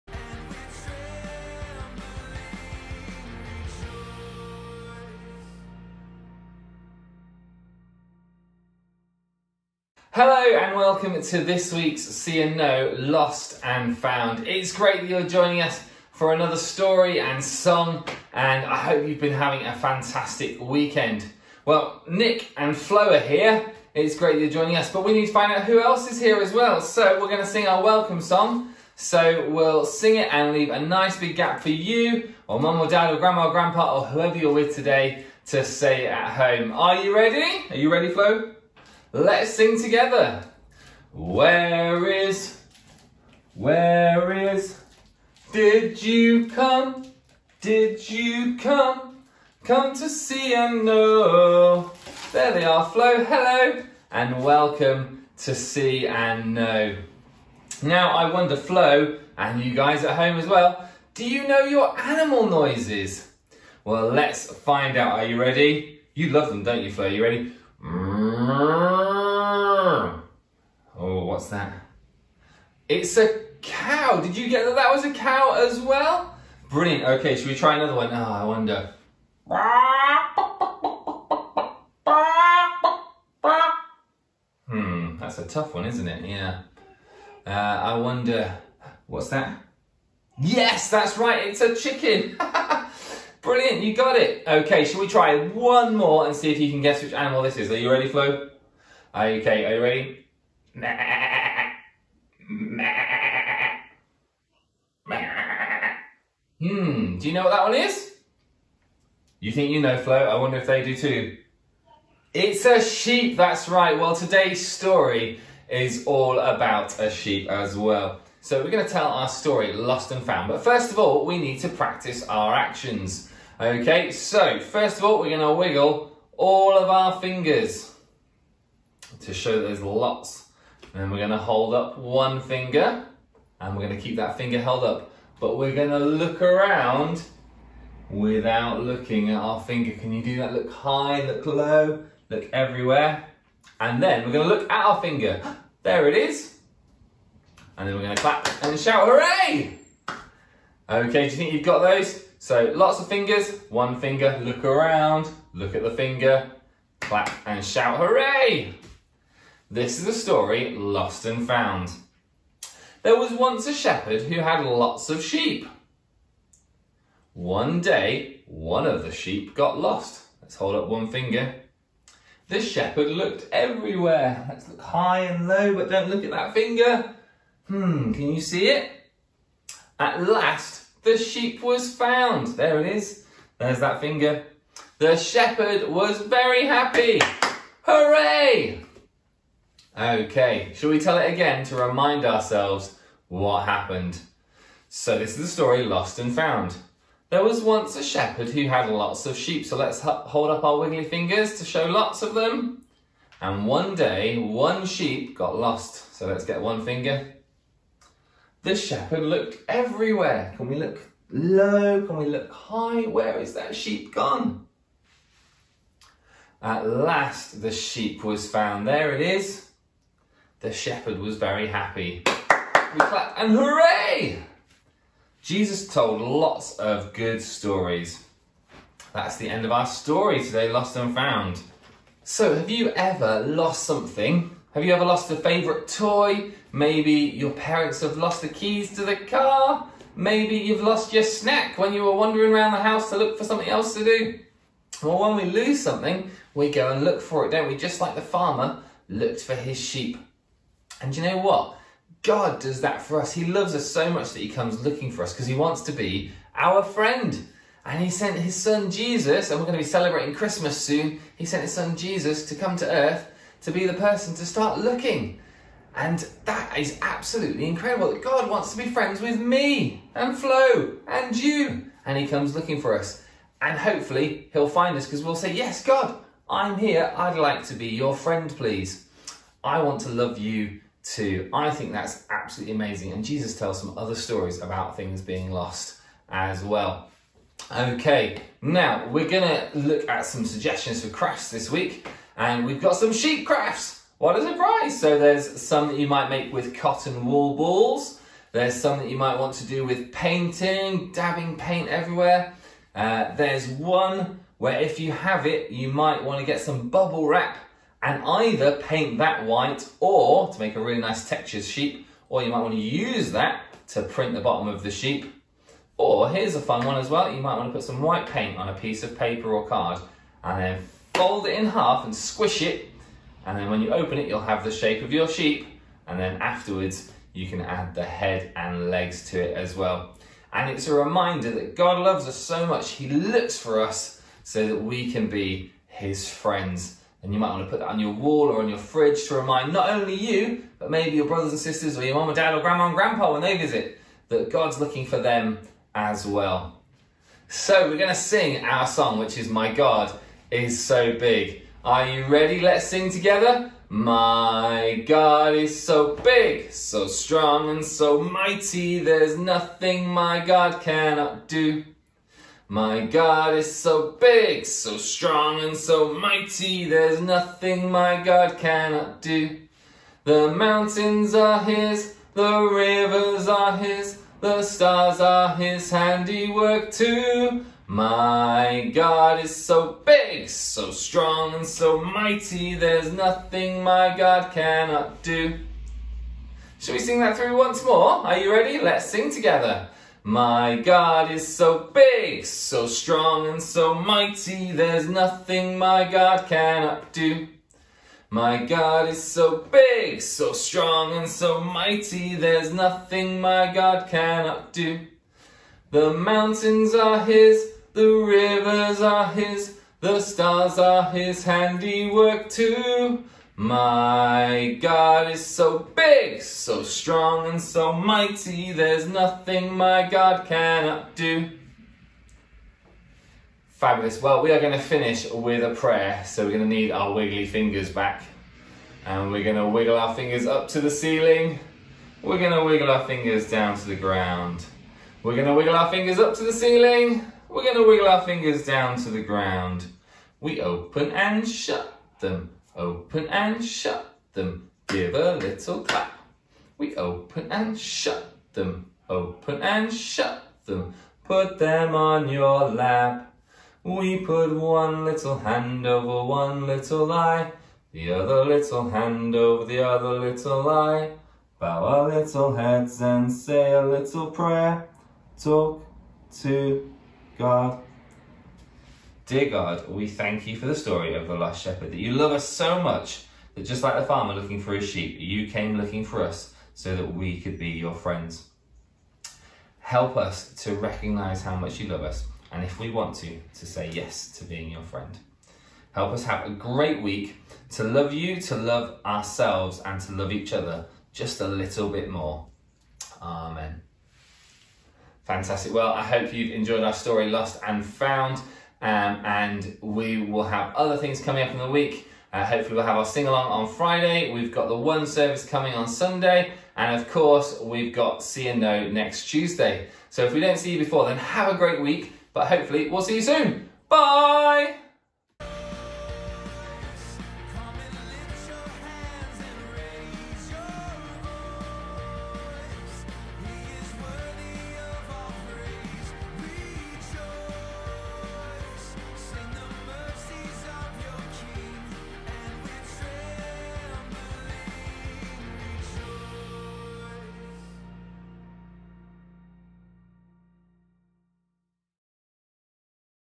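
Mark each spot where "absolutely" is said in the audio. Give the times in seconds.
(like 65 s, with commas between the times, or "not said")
267 s, 282 s.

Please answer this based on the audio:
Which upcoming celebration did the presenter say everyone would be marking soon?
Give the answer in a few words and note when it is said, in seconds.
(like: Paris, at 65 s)
Christmas, at 260 s.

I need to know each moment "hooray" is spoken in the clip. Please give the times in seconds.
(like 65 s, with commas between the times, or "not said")
149 s, 157 s, 187 s, 223 s.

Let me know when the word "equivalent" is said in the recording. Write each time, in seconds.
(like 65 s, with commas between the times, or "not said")
not said.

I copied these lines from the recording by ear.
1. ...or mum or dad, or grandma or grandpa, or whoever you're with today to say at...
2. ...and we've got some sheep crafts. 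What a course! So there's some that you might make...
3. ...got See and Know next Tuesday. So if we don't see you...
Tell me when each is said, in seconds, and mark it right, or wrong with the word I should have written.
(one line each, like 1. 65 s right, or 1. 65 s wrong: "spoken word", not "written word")
1. 32 s right
2. 292 s wrong: "surprise", not "course"
3. 507 s right.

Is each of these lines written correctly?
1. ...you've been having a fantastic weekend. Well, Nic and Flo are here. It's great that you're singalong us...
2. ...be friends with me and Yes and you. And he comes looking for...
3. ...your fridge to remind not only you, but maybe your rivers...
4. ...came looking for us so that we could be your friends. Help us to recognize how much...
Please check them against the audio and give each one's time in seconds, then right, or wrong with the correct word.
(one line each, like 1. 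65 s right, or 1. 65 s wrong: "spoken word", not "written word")
1. 19 s wrong: "joining", not "singalong"
2. 268 s wrong: "Flo", not "Yes"
3. 338 s wrong: "brothers", not "rivers"
4. 475 s right.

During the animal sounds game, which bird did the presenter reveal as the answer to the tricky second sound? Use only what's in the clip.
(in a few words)
Chicken.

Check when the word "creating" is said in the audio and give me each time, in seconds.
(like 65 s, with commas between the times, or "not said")
not said.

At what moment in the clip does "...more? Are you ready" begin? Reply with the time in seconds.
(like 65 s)
387 s.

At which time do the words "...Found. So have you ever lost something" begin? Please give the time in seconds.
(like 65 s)
231 s.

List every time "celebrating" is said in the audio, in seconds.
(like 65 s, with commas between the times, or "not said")
259 s.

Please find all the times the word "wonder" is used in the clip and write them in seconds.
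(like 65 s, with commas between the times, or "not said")
58 s, 83 s, 87 s, 110 s.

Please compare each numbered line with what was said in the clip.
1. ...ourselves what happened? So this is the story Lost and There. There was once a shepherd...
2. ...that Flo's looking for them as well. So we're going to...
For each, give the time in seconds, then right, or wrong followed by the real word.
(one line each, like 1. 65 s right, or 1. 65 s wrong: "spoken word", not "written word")
1. 192 s wrong: "Found", not "There"
2. 344 s wrong: "God", not "Flo".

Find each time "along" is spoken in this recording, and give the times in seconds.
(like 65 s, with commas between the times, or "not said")
503 s.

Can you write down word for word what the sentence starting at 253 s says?
He loves us so much that he comes looking for us because he wants to be our friend.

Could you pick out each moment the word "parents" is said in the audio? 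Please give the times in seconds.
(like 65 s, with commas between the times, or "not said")
237 s.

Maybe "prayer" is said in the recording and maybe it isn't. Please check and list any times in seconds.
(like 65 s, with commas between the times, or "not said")
425 s, 464 s.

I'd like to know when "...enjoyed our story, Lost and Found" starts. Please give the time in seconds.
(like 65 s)
496 s.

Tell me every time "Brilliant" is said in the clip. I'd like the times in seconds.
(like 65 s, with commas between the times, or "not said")
76 s, 93 s.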